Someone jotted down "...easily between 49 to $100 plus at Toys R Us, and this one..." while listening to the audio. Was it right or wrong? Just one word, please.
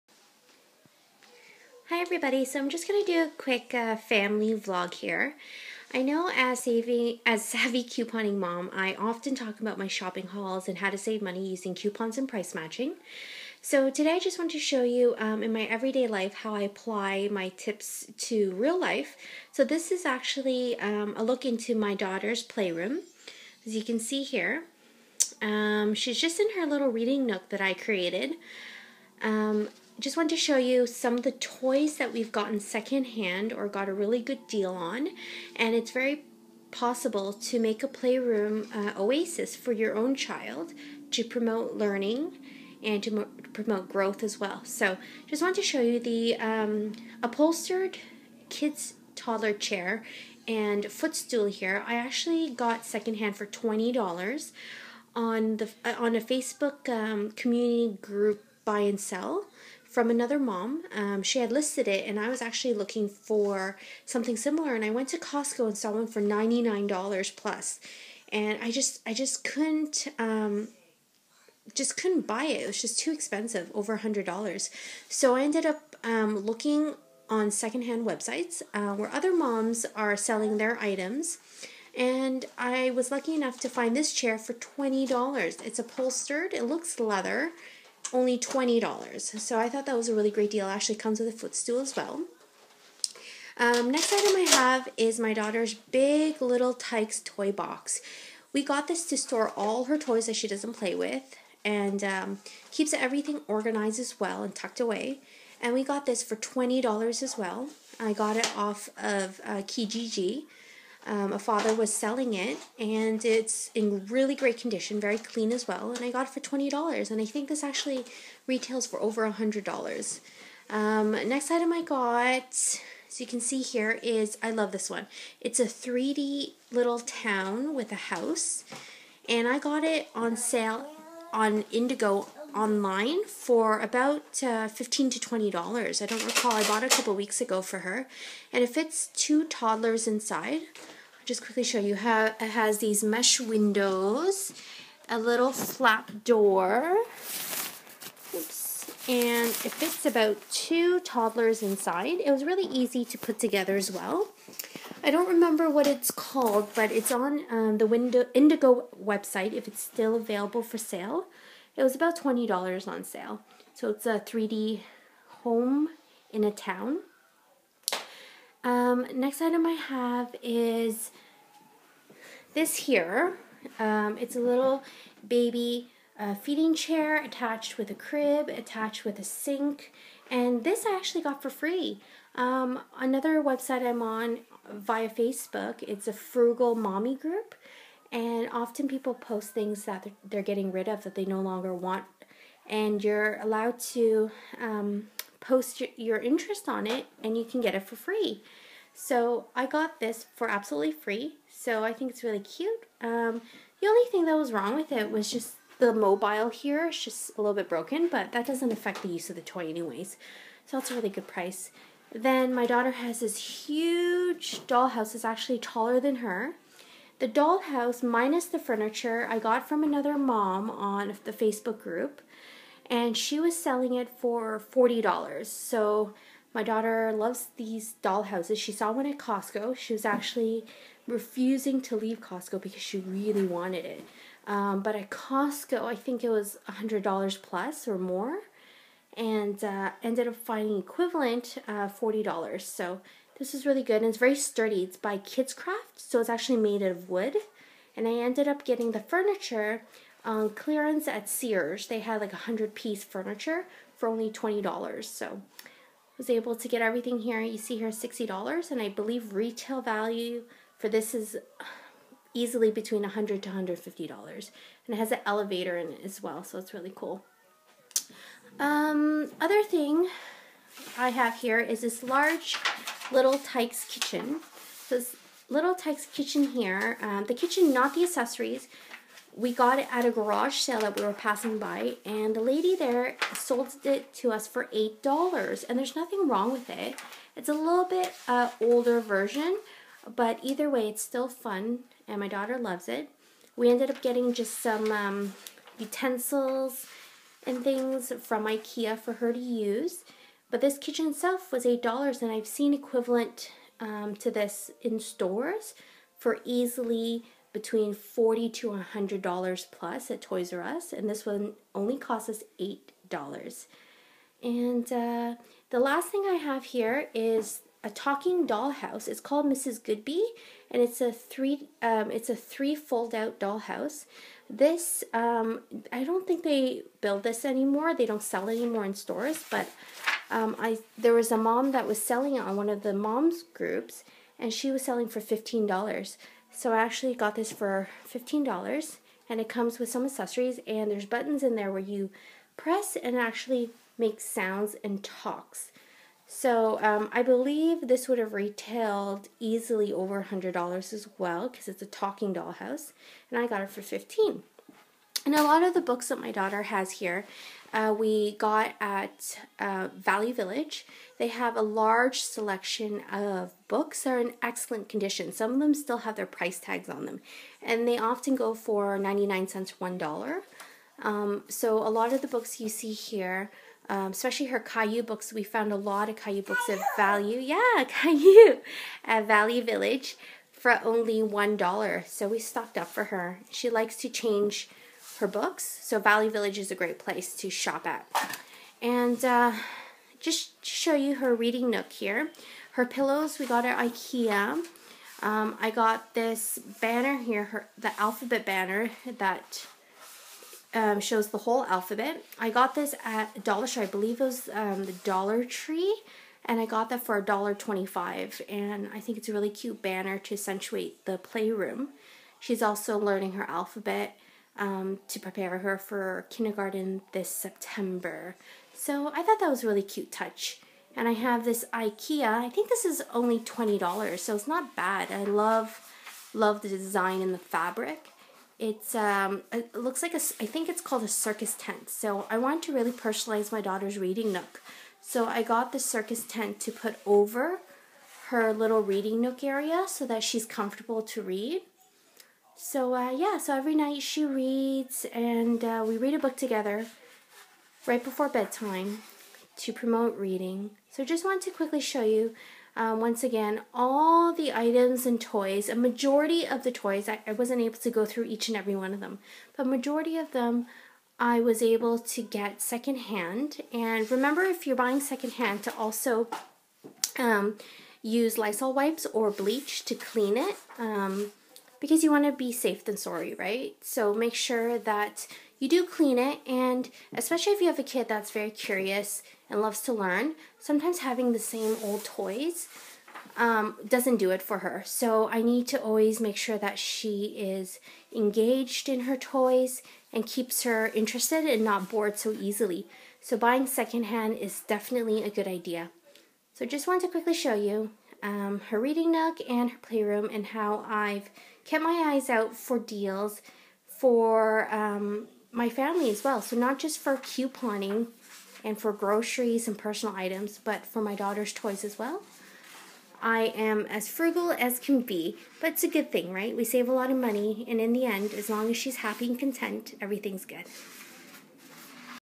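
wrong.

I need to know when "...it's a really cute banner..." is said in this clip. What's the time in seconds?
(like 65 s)
409 s.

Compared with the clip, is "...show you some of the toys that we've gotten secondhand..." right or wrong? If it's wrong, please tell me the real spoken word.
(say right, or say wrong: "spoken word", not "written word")
right.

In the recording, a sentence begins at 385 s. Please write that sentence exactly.
So Value Village is a great place to shop at.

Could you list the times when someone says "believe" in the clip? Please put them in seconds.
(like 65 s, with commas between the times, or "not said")
258 s, 347 s, 403 s.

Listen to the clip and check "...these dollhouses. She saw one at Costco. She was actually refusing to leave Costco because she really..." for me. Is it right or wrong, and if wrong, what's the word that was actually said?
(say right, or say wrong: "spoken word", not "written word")
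right.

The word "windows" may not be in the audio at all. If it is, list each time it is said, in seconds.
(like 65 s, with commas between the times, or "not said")
143 s, 157 s.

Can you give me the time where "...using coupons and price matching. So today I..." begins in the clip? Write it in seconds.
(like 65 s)
11 s.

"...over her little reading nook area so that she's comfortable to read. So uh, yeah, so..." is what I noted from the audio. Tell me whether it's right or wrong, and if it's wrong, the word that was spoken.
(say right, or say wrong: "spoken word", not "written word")
right.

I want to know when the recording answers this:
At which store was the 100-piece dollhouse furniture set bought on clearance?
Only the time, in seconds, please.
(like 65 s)
251 s.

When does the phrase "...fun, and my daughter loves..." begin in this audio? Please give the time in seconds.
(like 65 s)
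291 s.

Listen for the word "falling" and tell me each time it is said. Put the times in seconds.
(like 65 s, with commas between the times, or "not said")
not said.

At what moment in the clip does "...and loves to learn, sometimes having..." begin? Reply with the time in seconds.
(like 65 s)
479 s.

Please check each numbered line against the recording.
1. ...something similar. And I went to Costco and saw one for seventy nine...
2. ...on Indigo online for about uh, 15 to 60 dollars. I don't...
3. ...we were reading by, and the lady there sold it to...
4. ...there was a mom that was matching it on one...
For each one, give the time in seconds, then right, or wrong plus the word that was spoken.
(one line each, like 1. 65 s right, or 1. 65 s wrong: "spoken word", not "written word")
1. 64 s wrong: "ninety", not "seventy"
2. 131 s wrong: "20", not "60"
3. 280 s wrong: "passing", not "reading"
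4. 330 s wrong: "selling", not "matching".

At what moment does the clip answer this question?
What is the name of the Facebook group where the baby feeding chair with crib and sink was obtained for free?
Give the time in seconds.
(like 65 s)
186 s.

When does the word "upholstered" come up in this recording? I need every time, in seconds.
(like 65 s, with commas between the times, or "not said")
47 s, 85 s.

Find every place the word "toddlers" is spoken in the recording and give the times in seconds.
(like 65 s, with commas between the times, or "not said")
49 s, 139 s, 150 s.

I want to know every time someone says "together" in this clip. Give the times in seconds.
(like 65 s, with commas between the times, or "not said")
153 s, 446 s.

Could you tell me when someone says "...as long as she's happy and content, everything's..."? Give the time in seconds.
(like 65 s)
518 s.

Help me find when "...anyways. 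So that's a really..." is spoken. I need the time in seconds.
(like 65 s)
209 s.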